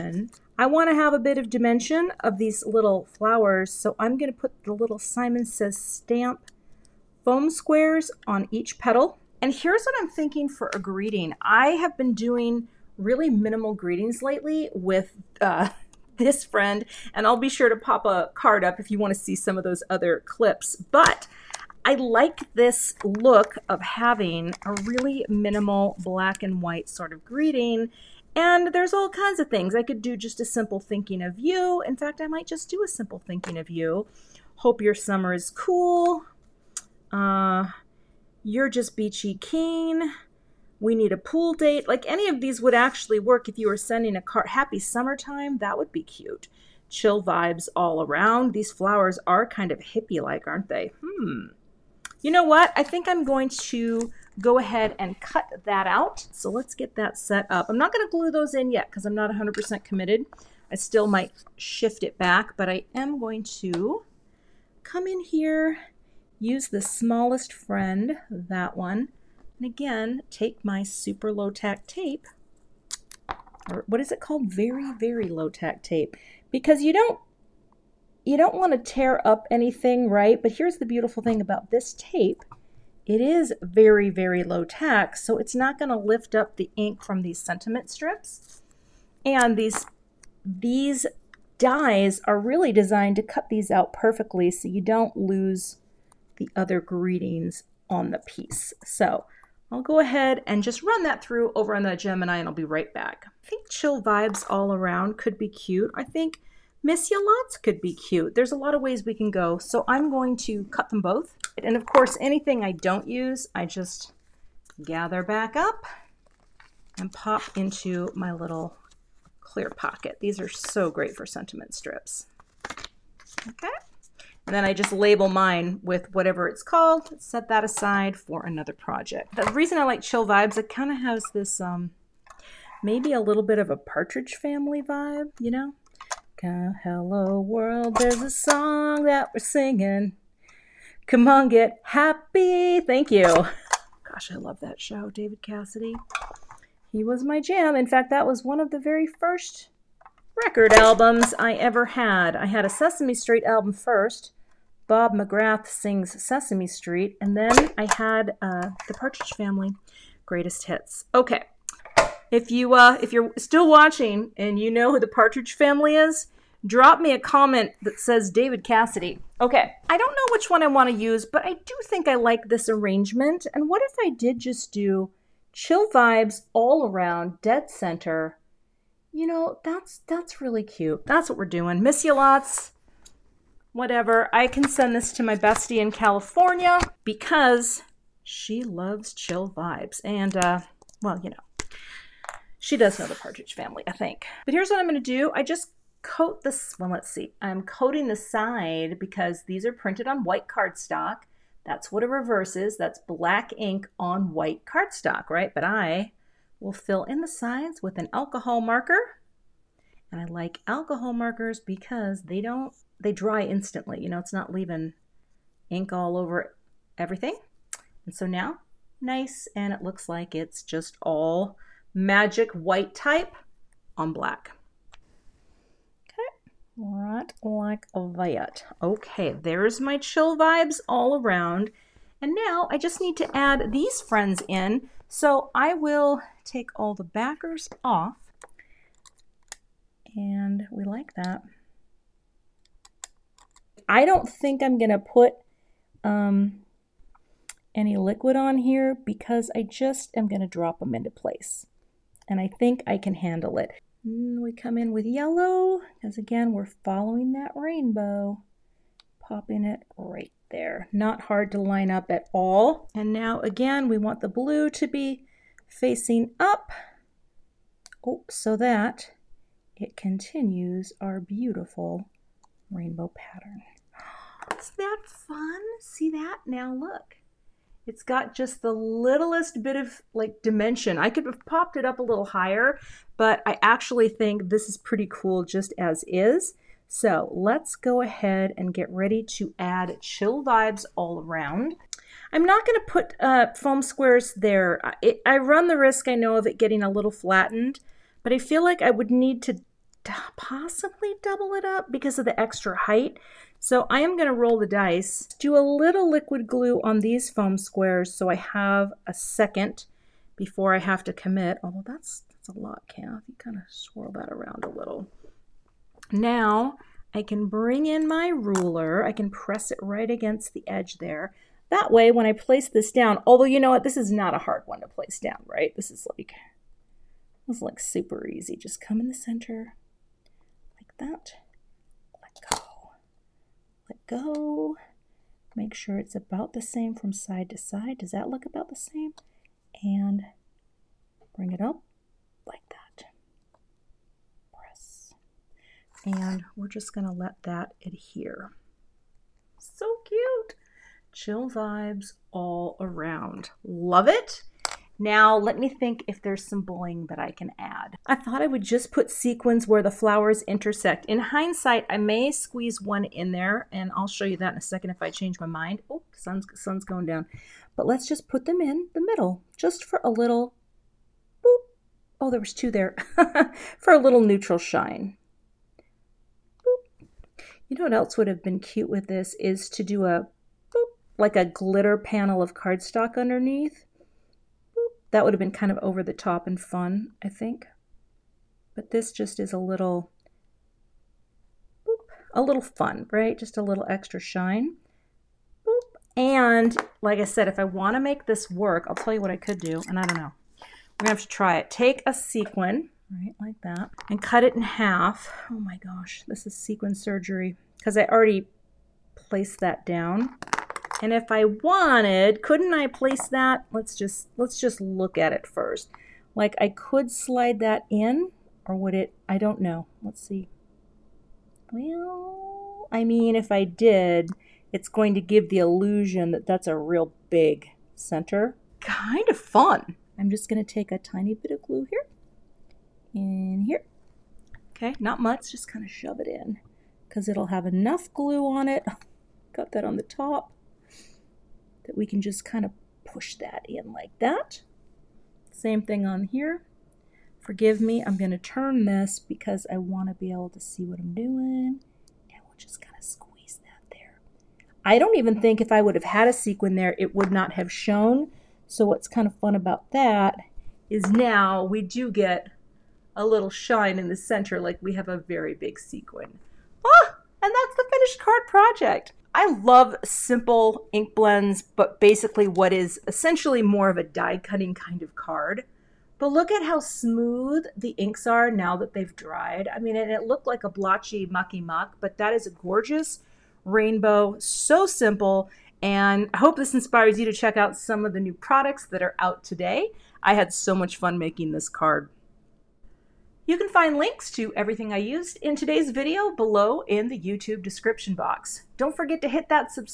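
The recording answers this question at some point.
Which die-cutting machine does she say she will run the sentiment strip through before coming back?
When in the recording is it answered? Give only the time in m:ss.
1:41.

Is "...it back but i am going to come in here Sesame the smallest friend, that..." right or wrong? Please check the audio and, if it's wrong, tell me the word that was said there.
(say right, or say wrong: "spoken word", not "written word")
wrong: "Use", not "Sesame".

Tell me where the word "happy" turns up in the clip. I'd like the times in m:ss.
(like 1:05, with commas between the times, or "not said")
0:44, 2:21.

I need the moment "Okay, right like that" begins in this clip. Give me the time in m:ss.
3:46.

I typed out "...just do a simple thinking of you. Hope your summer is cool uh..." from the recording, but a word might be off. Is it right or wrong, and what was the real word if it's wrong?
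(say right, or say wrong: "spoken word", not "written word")
right.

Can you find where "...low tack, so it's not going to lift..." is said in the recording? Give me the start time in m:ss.
1:24.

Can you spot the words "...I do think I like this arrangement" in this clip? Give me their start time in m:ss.
2:51.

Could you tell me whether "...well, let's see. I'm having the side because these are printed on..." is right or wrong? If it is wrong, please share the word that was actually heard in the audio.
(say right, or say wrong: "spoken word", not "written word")
wrong: "coating", not "having".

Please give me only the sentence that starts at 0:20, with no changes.
But I like this look of having a really minimal black and white sort of greeting.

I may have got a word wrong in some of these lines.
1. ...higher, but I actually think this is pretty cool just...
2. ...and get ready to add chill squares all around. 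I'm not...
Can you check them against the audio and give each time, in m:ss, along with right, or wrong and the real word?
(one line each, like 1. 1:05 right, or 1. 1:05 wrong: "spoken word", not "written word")
1. 4:42 right
2. 4:48 wrong: "vibes", not "squares".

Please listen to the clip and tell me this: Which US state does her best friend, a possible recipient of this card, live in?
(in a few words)
California.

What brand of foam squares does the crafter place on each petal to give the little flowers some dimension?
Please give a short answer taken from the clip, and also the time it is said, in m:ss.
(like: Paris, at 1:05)
Simon Says Stamp, at 0:05.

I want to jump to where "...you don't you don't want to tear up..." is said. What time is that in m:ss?
1:16.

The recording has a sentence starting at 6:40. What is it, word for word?
We're going to have to try it.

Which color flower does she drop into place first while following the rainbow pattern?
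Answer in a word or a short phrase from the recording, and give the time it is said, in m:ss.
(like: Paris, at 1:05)
yellow, at 4:15.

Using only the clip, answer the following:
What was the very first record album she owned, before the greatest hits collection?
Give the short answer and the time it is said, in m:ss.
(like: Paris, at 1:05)
Bob McGrath Sings Sesame Street, at 2:34.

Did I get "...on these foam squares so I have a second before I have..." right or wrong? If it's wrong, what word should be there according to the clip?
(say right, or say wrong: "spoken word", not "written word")
right.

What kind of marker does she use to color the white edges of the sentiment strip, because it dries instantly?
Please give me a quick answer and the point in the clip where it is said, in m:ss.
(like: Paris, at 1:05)
alcohol marker, at 3:28.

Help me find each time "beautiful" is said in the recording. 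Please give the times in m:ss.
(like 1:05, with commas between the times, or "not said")
1:20, 4:31.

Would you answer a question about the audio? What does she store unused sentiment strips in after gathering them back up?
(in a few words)
clear pocket.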